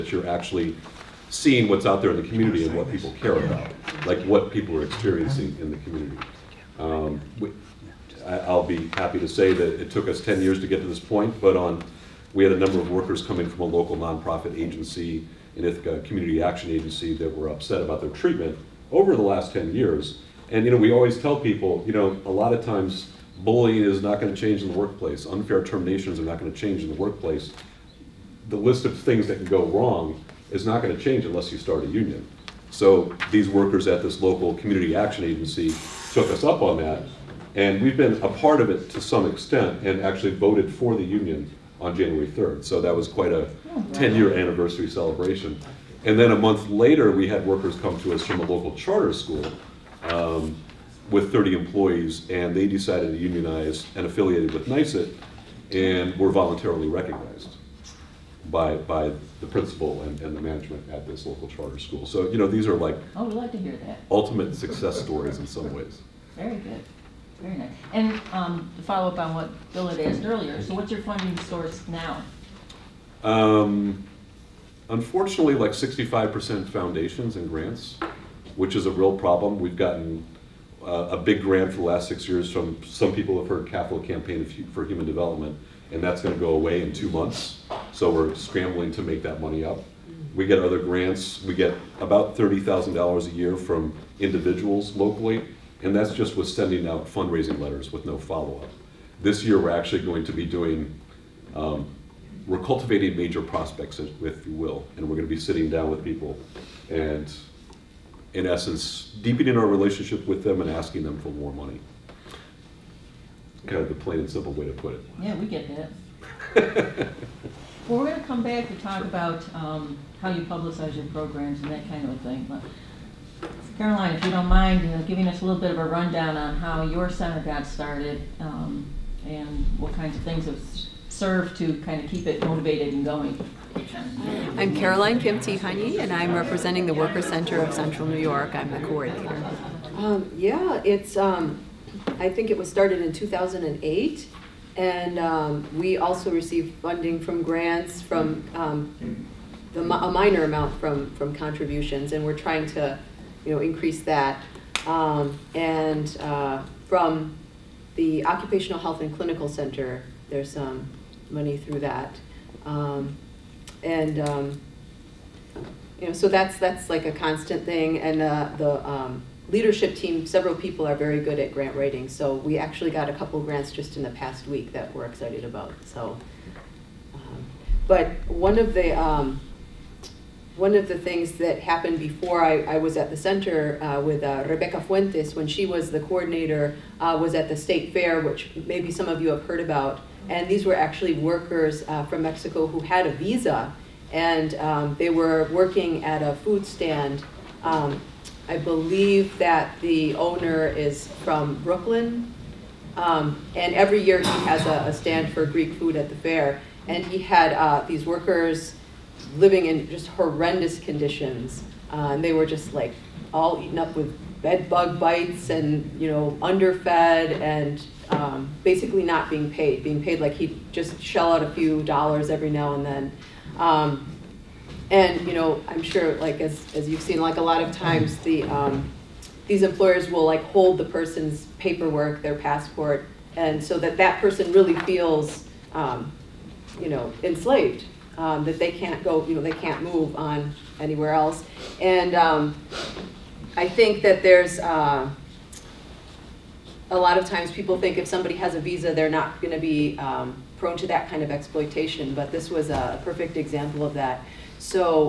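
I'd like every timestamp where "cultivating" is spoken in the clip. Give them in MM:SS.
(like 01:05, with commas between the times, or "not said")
01:42.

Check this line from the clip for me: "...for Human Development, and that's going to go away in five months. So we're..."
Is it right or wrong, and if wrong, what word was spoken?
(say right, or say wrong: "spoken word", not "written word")
wrong: "two", not "five".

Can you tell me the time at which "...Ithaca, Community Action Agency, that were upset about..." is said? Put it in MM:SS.
00:15.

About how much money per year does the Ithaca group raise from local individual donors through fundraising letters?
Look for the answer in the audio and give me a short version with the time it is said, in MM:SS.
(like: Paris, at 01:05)
$30,000, at 01:32.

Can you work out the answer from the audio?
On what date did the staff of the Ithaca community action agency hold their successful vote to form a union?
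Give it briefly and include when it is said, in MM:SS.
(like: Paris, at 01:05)
January 3rd, at 00:41.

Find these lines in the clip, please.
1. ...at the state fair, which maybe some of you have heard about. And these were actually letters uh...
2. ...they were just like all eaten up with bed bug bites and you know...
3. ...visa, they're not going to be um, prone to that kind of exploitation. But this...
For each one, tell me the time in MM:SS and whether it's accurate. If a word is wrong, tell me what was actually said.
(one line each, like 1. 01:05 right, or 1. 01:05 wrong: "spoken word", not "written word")
1. 03:07 wrong: "workers", not "letters"
2. 03:32 right
3. 04:08 right.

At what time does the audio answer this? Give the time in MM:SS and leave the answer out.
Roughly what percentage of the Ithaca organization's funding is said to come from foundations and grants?
01:15.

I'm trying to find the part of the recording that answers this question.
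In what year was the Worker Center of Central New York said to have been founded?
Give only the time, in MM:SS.
02:23.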